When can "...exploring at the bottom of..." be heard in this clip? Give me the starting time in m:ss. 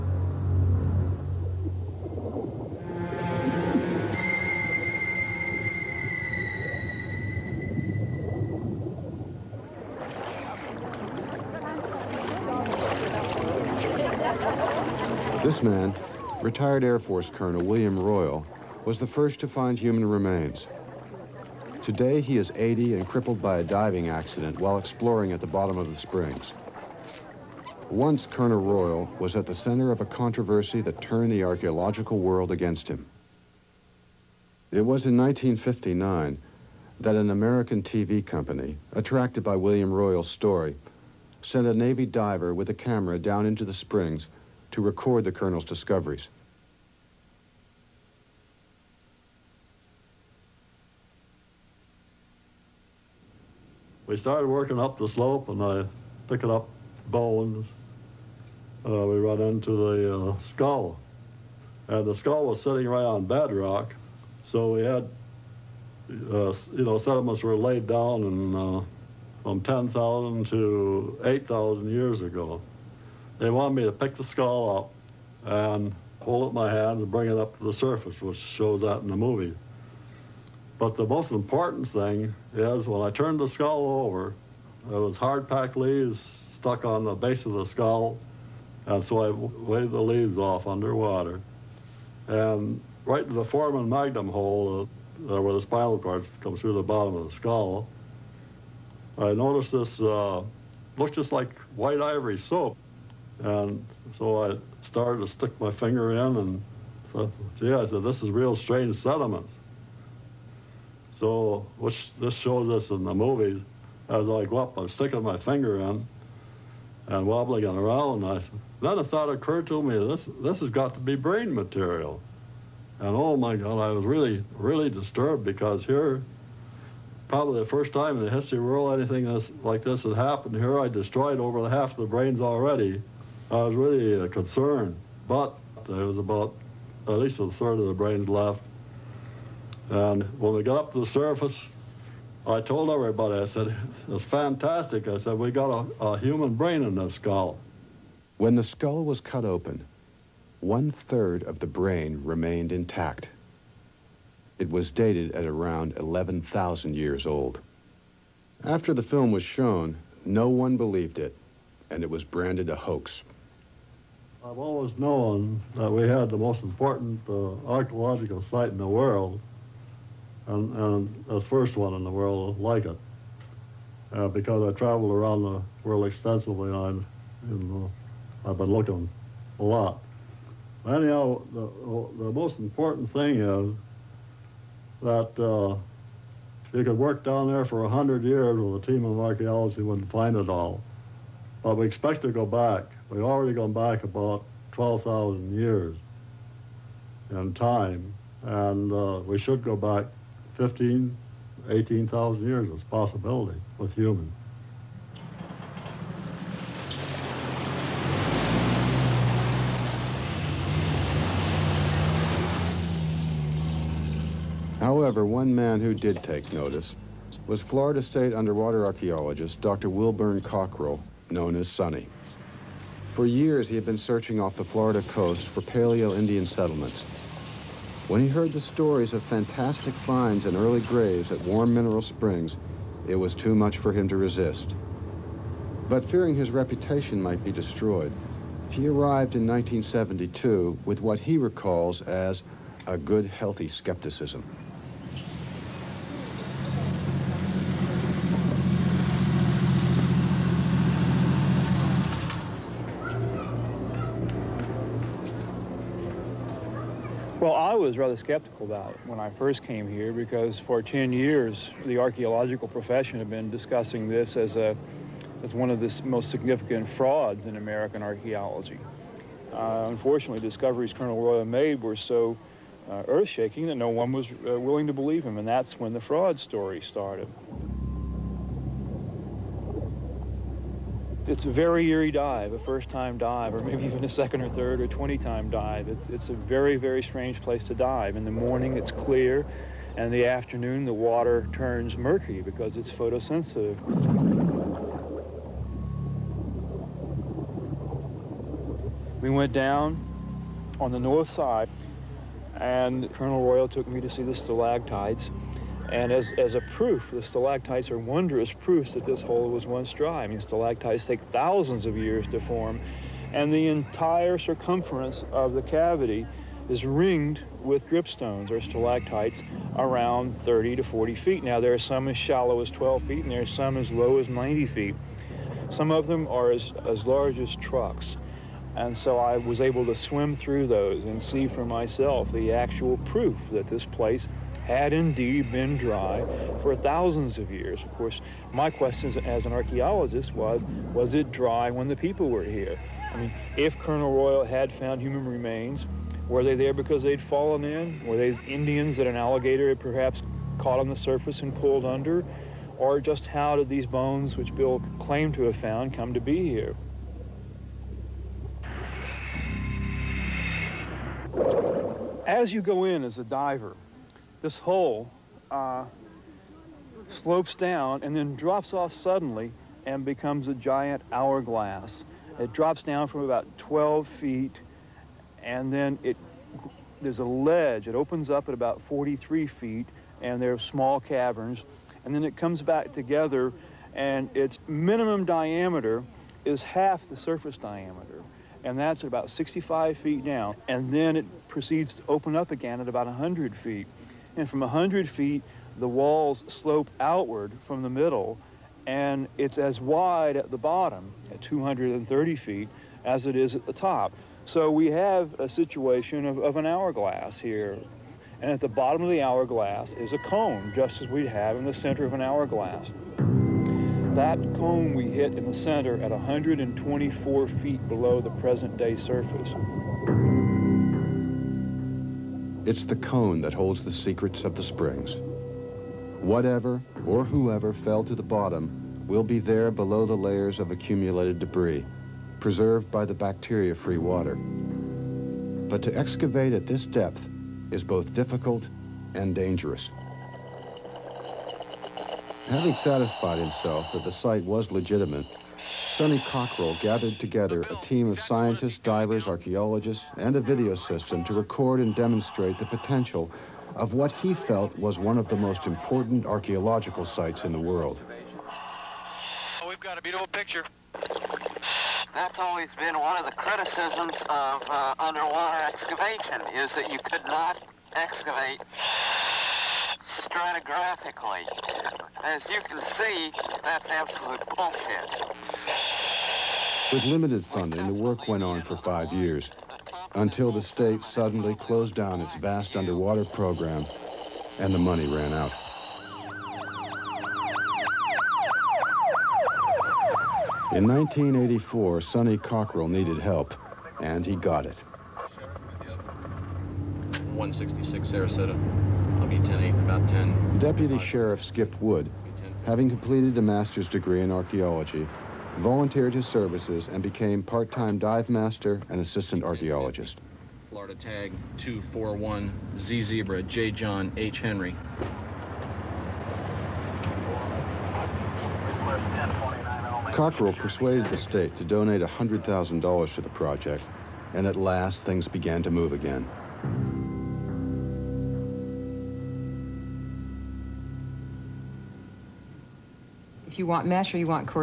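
0:24.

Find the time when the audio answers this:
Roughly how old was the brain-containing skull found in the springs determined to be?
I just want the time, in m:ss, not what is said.
2:35.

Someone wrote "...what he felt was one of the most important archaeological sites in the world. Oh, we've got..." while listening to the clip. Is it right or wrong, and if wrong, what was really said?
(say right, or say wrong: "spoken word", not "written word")
right.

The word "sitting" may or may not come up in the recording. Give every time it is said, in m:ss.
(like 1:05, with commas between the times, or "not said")
1:02.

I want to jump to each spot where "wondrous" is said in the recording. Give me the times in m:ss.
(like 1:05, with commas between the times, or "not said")
5:07.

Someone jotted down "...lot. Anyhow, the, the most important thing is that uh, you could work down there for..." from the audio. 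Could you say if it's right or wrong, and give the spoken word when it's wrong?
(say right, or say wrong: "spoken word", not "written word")
right.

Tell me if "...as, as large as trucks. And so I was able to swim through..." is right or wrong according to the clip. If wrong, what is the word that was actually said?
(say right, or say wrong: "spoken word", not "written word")
right.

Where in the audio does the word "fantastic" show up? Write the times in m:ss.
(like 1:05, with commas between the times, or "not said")
2:24, 3:49.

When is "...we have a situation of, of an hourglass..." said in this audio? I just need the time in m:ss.
6:44.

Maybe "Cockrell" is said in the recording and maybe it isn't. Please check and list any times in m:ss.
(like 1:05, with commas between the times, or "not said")
3:40, 7:26, 8:12, 8:40.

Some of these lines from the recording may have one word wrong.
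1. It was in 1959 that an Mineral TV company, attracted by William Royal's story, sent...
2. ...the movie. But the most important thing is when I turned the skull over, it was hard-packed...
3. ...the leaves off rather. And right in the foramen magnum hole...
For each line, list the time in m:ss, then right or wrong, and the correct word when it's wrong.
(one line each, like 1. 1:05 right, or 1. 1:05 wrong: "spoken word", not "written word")
1. 0:34 wrong: "American", not "Mineral"
2. 1:19 right
3. 1:29 wrong: "underwater", not "rather".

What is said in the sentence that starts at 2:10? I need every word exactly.
Here I destroyed over half the brains already.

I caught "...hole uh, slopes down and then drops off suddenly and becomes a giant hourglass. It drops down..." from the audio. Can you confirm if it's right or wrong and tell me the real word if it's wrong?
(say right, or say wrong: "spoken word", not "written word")
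right.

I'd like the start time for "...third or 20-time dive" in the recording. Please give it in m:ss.
4:44.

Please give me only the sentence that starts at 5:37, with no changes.
Of course, my question as an archaeologist was, was it dry when the people were here?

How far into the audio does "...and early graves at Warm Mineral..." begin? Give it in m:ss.
3:50.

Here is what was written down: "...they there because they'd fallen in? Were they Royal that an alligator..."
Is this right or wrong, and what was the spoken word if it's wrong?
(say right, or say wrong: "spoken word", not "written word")
wrong: "Indians", not "Royal".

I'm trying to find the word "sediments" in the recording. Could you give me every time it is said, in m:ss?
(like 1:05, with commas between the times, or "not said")
1:06, 1:48.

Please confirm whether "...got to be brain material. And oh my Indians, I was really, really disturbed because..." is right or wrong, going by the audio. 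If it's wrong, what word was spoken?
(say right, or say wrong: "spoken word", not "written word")
wrong: "God", not "Indians".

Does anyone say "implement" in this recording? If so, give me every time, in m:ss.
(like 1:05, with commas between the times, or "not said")
not said.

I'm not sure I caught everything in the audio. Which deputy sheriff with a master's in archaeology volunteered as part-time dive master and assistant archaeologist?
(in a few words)
Skip Wood.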